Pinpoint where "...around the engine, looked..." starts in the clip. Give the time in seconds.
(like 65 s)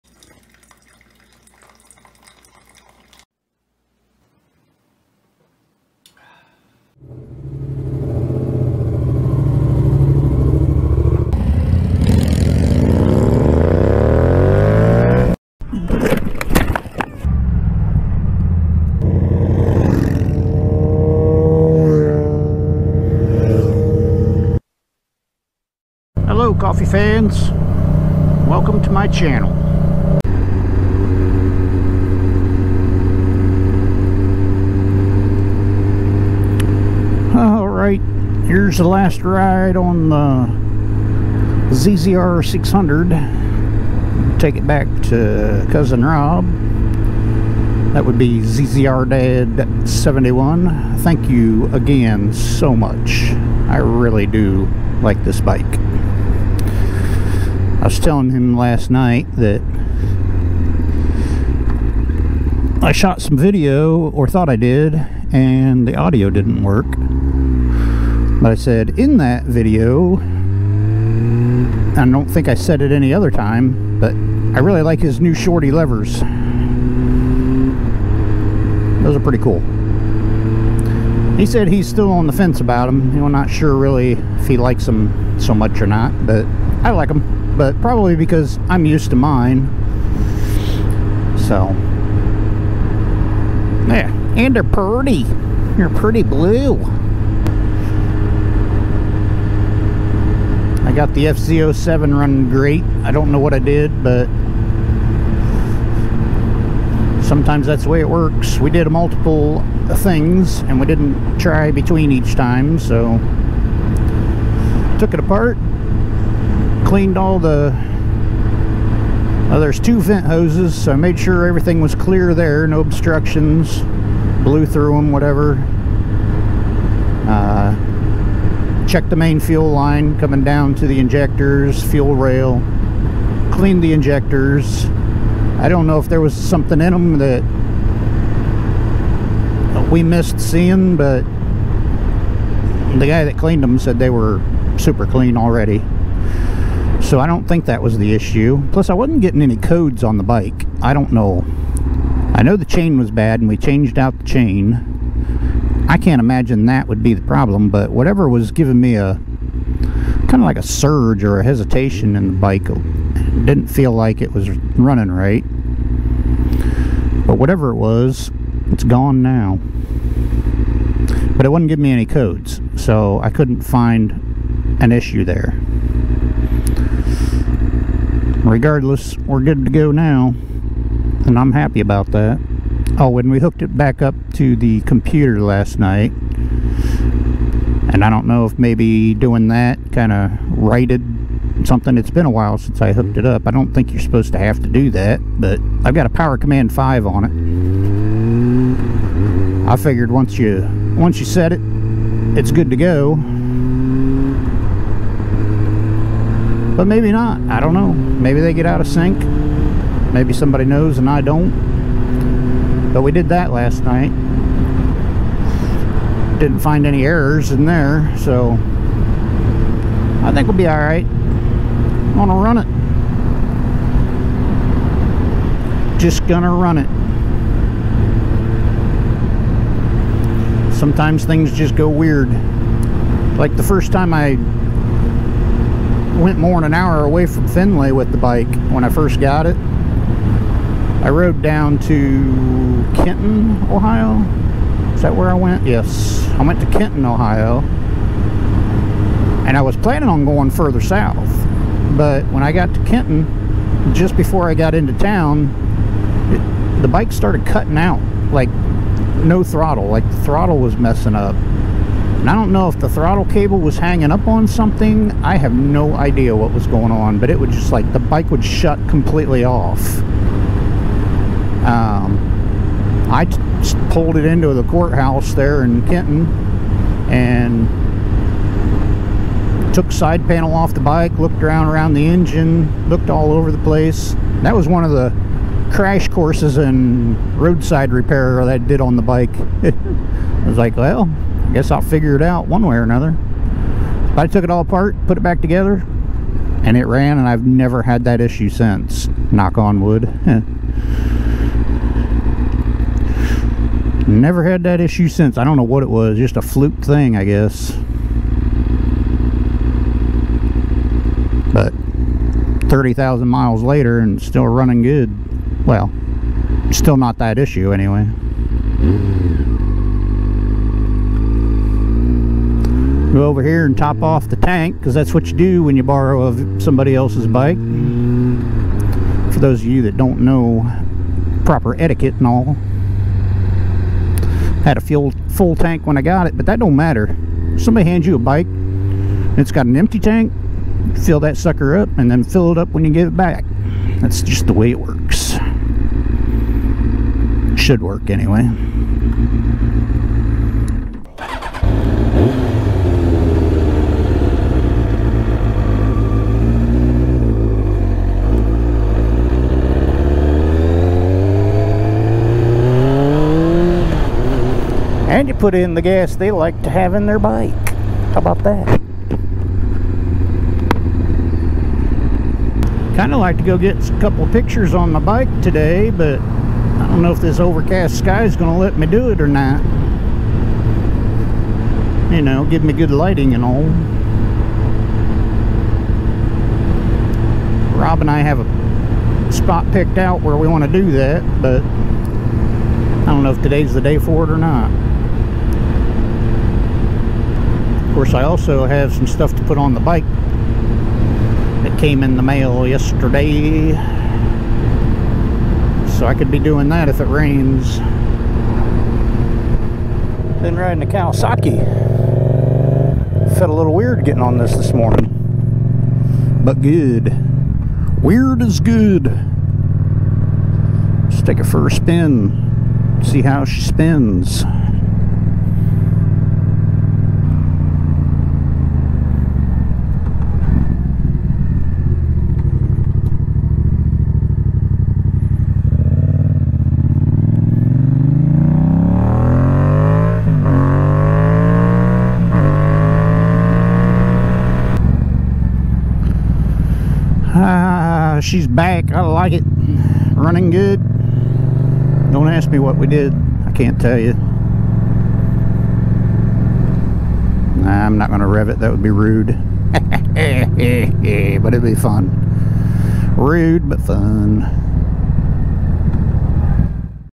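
281 s.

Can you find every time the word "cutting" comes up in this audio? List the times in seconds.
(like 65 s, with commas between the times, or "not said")
257 s.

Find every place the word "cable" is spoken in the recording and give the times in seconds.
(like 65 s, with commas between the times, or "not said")
263 s.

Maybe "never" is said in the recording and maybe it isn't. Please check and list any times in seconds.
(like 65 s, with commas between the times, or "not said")
297 s, 304 s.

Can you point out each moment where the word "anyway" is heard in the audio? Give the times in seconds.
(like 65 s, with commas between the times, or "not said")
317 s, 348 s.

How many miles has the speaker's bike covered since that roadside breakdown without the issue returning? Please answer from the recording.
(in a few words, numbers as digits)
30,000.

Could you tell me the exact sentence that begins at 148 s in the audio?
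Plus, I wasn't getting any codes on the bike.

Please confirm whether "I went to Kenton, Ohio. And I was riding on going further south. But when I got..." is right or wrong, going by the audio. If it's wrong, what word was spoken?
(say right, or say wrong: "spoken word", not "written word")
wrong: "planning", not "riding".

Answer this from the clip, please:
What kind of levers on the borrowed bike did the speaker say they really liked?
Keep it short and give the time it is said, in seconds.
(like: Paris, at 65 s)
Shorty levers, at 75 s.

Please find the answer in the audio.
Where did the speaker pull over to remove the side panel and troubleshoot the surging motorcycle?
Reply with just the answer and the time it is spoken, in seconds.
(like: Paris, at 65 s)
The courthouse, at 274 s.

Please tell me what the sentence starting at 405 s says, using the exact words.
So I could be doing that if it rains.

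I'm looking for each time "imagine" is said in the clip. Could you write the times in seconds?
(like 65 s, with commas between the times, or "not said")
156 s.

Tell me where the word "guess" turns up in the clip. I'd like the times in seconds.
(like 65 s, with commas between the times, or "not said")
291 s, 307 s.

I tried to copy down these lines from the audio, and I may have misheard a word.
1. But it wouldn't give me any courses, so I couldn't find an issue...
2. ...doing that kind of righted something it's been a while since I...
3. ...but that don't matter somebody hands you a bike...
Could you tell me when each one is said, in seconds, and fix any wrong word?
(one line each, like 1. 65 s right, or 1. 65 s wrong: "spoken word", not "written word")
1. 171 s wrong: "codes", not "courses"
2. 189 s right
3. 336 s right.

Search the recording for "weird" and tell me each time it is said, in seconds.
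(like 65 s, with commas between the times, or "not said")
231 s, 413 s, 418 s.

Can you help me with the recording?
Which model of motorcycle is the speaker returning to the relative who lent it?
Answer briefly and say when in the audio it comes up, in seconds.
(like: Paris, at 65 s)
ZZR 600, at 41 s.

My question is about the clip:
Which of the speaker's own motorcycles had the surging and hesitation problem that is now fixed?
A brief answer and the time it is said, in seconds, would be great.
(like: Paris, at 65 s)
FZ07, at 101 s.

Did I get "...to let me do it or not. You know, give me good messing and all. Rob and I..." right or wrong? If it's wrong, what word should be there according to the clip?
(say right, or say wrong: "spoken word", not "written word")
wrong: "lighting", not "messing".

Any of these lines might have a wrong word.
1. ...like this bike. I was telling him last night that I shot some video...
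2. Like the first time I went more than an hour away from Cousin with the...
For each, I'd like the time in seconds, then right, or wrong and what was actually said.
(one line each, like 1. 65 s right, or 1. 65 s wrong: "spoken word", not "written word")
1. 55 s right
2. 233 s wrong: "Findlay", not "Cousin".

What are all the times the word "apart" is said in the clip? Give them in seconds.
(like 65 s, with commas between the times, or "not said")
115 s, 294 s.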